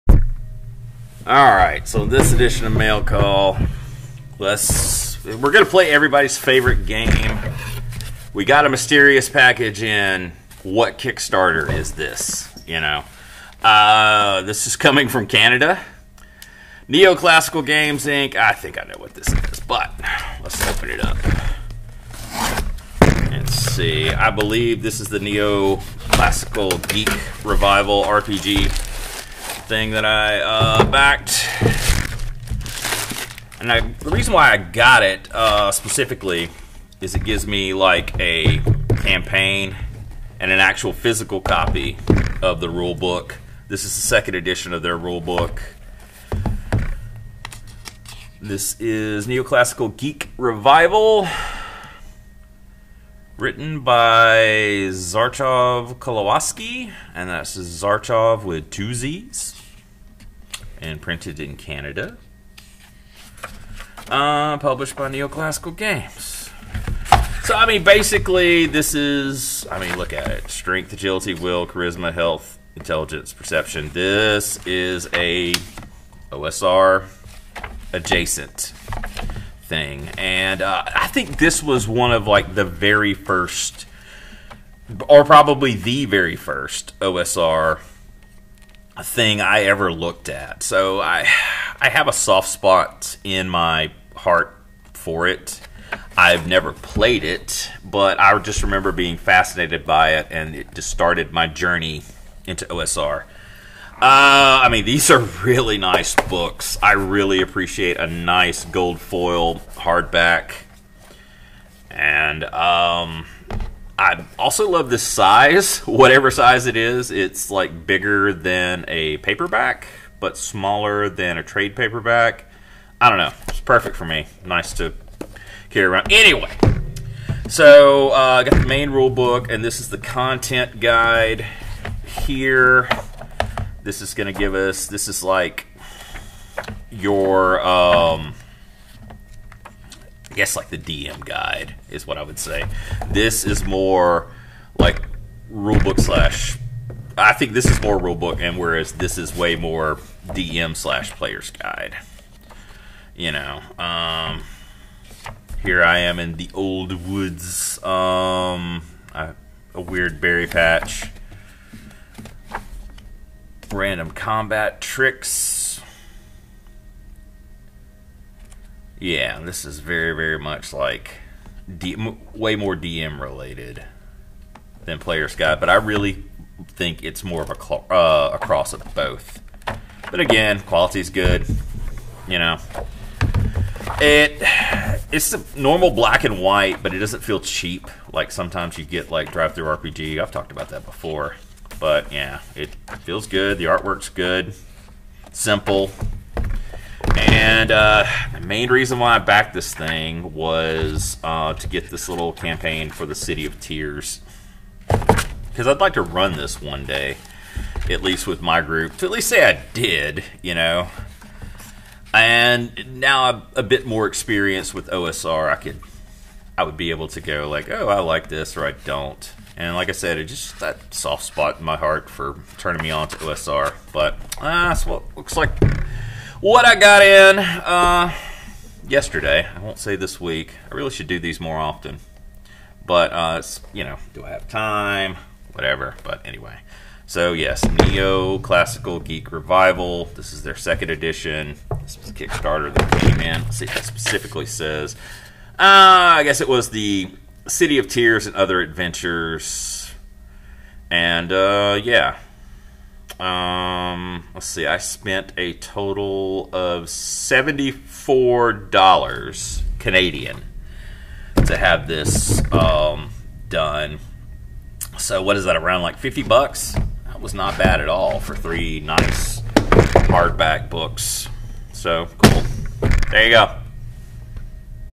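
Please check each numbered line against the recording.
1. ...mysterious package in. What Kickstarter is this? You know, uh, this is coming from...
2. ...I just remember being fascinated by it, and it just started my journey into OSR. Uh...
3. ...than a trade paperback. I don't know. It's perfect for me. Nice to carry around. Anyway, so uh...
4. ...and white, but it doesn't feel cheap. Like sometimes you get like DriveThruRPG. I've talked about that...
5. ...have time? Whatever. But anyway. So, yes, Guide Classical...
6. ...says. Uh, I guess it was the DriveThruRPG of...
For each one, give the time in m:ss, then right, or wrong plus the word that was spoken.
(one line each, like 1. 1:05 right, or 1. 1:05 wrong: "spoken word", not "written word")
1. 0:08 right
2. 1:38 right
3. 2:01 right
4. 3:06 right
5. 3:54 wrong: "Neo", not "Guide"
6. 4:04 wrong: "City", not "DriveThruRPG".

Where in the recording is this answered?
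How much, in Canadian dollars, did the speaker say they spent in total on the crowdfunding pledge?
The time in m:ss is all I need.
4:16.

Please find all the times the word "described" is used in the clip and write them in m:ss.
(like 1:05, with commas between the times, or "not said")
not said.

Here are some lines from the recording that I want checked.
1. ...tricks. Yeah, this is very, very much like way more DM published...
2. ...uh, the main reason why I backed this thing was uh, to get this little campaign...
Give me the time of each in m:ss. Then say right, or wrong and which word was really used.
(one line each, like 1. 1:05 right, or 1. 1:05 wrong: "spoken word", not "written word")
1. 2:44 wrong: "related", not "published"
2. 3:17 right.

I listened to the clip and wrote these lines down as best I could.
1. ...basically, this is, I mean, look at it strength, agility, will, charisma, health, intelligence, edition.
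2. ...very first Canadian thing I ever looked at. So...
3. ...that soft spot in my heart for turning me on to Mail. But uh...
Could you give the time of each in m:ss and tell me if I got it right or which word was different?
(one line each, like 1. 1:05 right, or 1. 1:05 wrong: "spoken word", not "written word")
1. 1:07 wrong: "perception", not "edition"
2. 1:26 wrong: "OSR", not "Canadian"
3. 3:40 wrong: "OSR", not "Mail".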